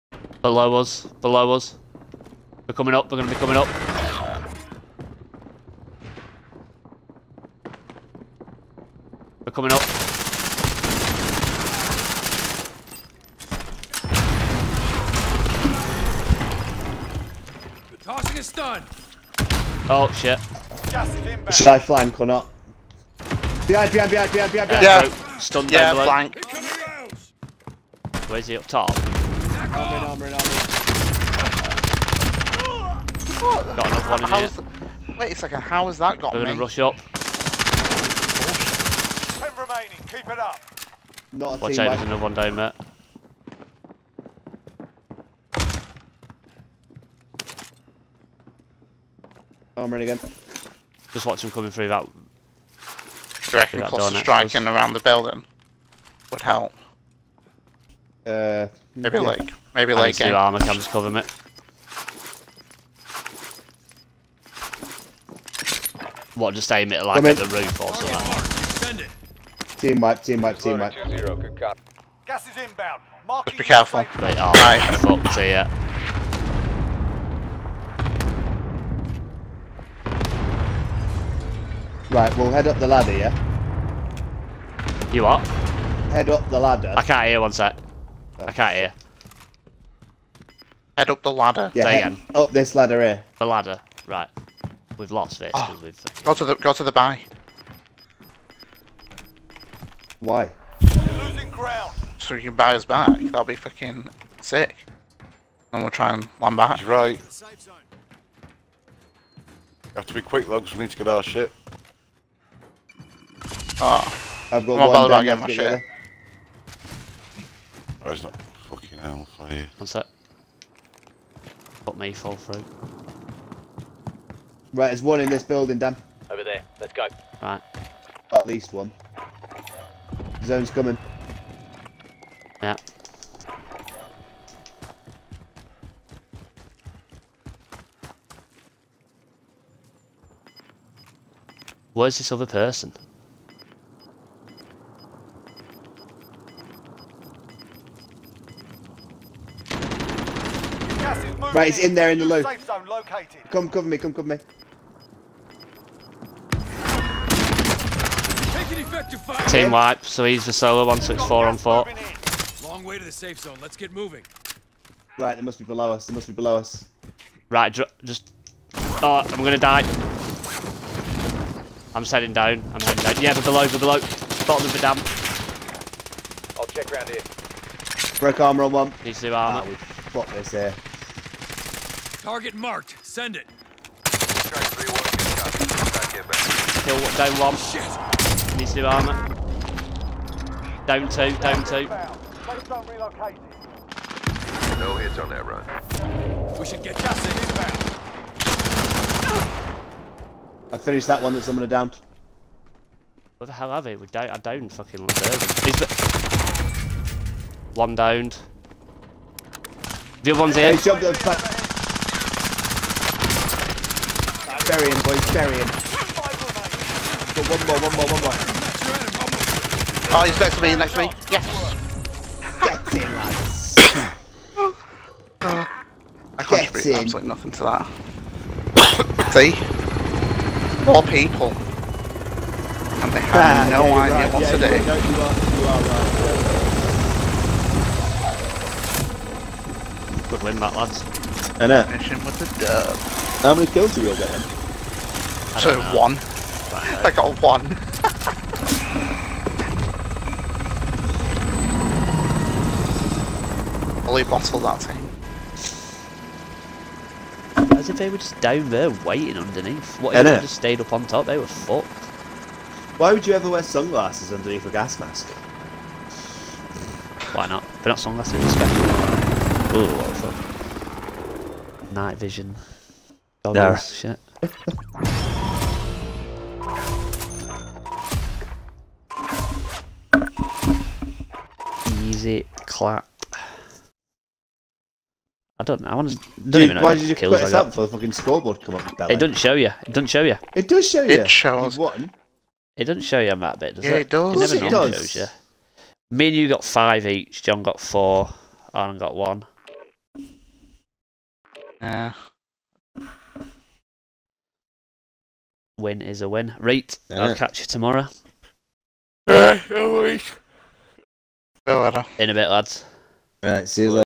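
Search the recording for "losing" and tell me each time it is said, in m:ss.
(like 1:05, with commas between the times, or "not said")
1:41.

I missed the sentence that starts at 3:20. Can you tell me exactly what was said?
I finished that one that someone had downed.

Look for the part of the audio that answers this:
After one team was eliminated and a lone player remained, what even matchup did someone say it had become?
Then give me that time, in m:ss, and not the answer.
2:41.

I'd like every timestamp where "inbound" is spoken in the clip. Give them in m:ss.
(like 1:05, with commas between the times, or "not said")
1:12, 3:17.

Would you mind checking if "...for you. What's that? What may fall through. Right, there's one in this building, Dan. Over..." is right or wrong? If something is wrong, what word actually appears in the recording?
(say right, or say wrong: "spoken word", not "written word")
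right.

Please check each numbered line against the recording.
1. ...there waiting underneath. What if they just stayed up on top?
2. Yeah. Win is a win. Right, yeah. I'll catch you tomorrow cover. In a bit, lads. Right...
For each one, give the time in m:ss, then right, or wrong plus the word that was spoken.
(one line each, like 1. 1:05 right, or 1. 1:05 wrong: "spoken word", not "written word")
1. 4:18 right
2. 5:01 wrong: "later", not "cover".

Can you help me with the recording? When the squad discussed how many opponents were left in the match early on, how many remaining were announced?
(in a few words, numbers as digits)
10.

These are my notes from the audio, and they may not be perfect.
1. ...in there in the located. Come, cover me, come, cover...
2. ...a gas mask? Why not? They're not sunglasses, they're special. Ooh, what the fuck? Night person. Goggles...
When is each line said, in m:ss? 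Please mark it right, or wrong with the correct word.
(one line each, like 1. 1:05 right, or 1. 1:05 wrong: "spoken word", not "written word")
1. 2:31 right
2. 4:24 wrong: "vision", not "person".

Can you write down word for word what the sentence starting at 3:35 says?
Got one more, one more, one more.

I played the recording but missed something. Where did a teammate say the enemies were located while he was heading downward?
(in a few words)
Bottom of the dam.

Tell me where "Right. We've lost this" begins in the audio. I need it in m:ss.
1:34.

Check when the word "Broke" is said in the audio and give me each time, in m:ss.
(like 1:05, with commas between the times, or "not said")
2:58.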